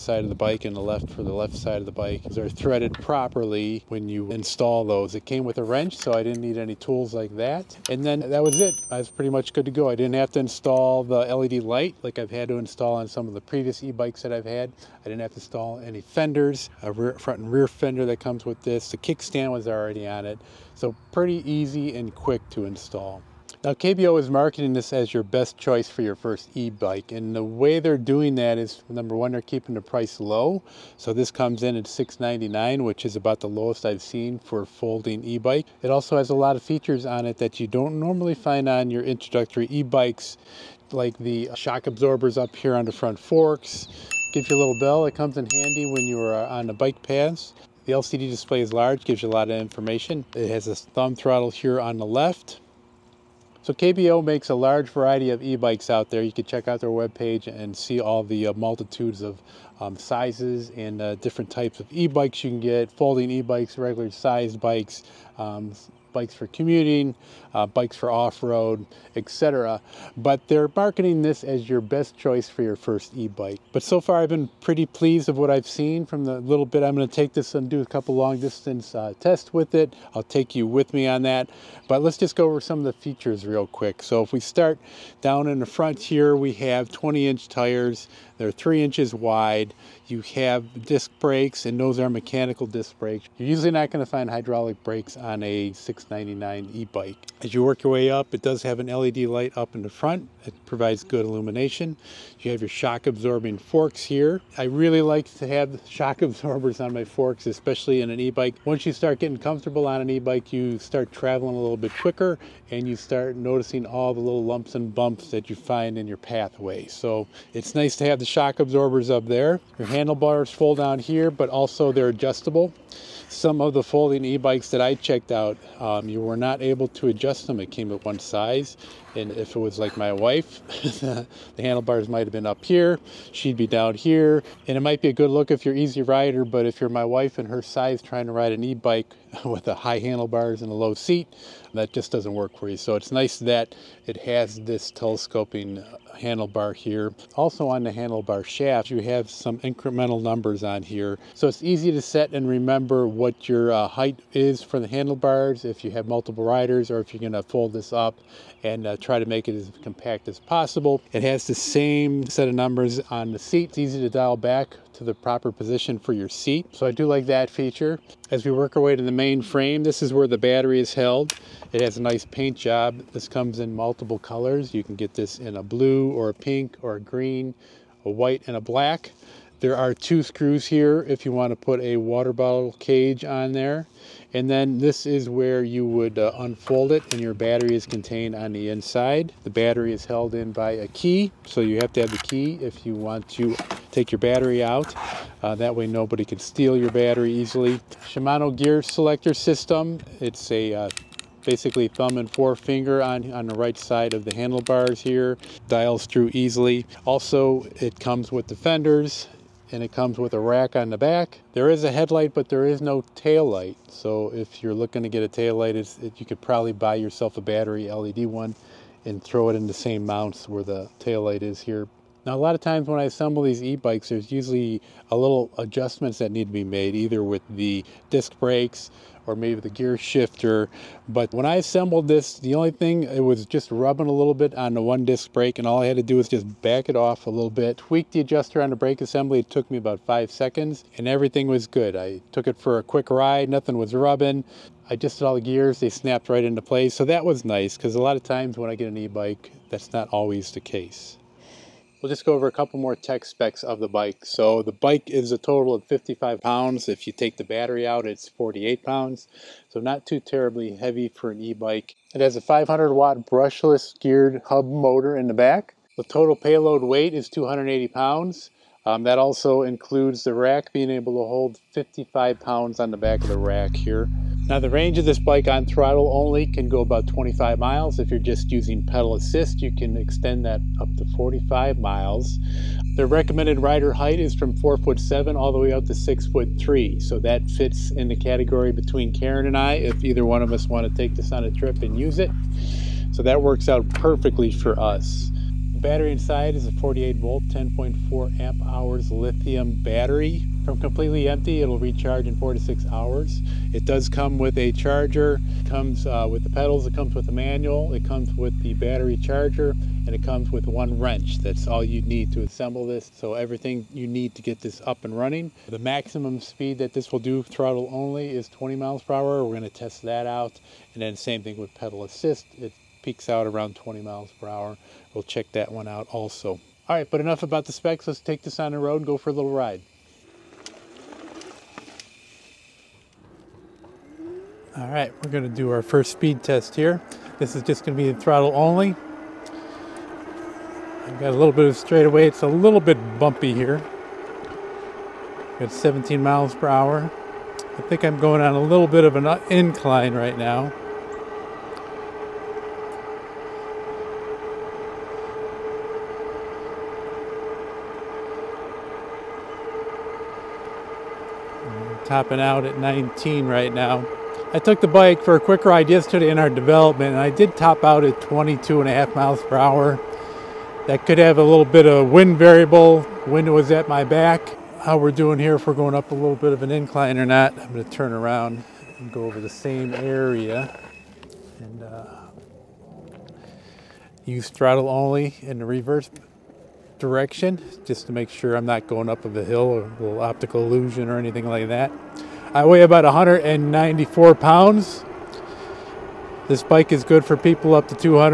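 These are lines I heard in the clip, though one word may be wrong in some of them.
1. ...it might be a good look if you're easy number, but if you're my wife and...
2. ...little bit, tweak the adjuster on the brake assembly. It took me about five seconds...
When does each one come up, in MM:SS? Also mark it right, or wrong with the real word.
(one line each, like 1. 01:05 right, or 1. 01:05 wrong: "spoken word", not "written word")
1. 02:14 wrong: "rider", not "number"
2. 03:57 right.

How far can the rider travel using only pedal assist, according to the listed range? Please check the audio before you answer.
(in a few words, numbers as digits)
45 miles.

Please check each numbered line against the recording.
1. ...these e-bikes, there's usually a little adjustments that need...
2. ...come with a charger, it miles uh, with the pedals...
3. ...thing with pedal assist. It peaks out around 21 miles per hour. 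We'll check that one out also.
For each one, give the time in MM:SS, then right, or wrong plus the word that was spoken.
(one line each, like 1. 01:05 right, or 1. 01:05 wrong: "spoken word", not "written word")
1. 03:43 right
2. 05:04 wrong: "comes", not "miles"
3. 05:21 wrong: "20", not "21".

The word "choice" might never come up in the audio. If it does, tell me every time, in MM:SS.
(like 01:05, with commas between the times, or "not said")
00:25, 01:12.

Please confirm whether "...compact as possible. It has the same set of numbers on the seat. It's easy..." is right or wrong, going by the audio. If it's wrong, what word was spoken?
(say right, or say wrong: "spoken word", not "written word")
right.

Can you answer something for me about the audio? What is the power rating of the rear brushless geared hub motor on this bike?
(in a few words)
500 watt.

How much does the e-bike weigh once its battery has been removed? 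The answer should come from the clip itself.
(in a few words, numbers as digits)
48 pounds.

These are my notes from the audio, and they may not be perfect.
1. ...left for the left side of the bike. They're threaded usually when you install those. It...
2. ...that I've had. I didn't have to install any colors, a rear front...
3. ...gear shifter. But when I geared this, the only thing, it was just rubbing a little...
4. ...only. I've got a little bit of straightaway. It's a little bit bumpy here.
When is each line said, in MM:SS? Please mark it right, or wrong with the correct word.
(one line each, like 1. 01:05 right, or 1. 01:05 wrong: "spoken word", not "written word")
1. 00:00 wrong: "properly", not "usually"
2. 00:14 wrong: "fenders", not "colors"
3. 03:49 wrong: "assembled", not "geared"
4. 05:38 right.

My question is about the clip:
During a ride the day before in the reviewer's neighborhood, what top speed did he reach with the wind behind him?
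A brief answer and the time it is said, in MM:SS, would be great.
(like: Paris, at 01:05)
22.5 mph, at 06:08.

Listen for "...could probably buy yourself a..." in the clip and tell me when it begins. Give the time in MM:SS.
03:36.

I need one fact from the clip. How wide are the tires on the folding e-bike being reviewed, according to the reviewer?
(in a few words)
3 inches.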